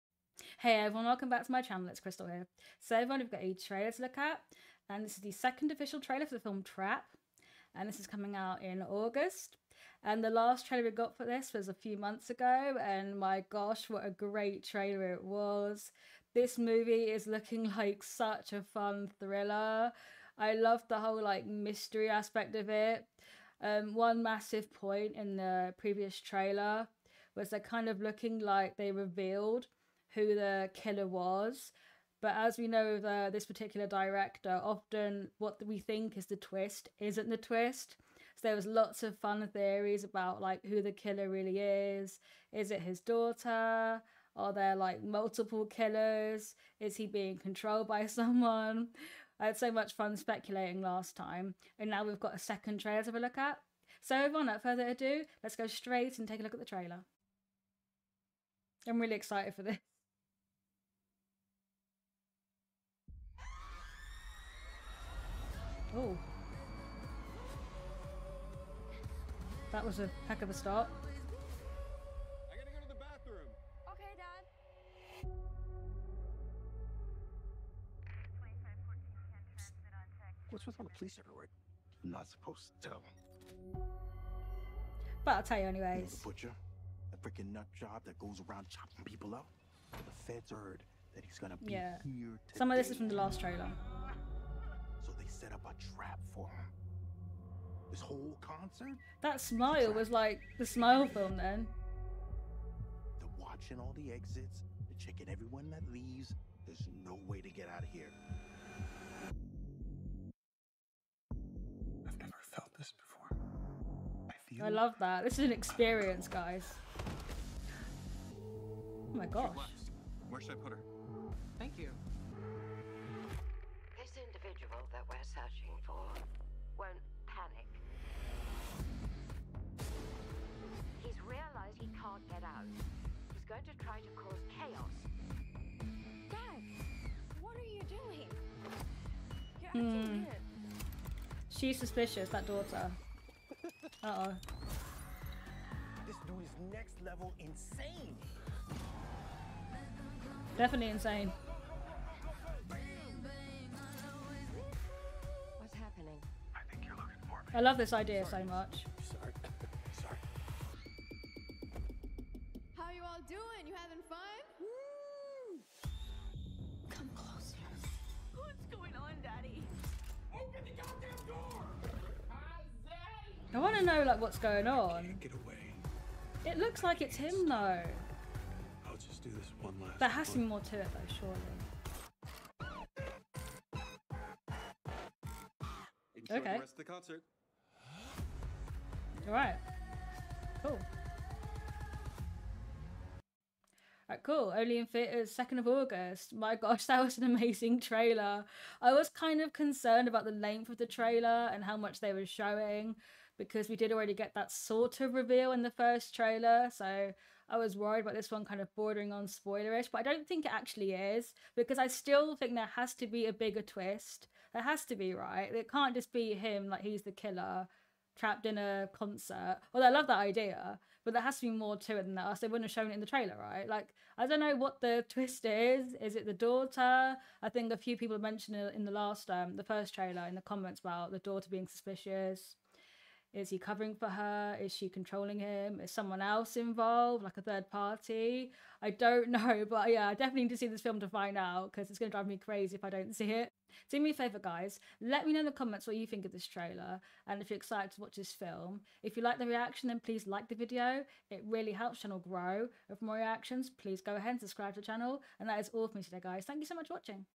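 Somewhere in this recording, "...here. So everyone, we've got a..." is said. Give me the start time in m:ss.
0:02.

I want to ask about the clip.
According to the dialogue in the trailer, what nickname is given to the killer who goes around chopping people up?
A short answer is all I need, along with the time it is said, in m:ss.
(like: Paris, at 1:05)
The Butcher, at 1:26.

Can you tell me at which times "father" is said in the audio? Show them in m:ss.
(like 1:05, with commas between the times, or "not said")
not said.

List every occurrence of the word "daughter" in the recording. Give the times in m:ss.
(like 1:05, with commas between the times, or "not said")
0:42, 2:22, 3:46, 3:51.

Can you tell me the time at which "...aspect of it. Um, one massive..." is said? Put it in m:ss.
0:22.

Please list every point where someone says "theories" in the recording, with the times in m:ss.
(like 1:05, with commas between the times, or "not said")
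0:39.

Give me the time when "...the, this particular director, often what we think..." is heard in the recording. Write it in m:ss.
0:32.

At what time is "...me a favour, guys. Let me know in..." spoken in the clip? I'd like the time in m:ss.
4:04.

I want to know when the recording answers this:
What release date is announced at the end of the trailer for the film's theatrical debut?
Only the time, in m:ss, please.
3:15.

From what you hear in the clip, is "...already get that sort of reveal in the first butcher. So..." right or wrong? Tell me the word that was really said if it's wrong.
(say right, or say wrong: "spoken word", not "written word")
wrong: "trailer", not "butcher".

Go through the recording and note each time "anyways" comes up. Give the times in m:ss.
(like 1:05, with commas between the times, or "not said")
1:25.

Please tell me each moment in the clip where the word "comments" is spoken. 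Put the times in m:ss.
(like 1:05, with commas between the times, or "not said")
3:50, 4:05.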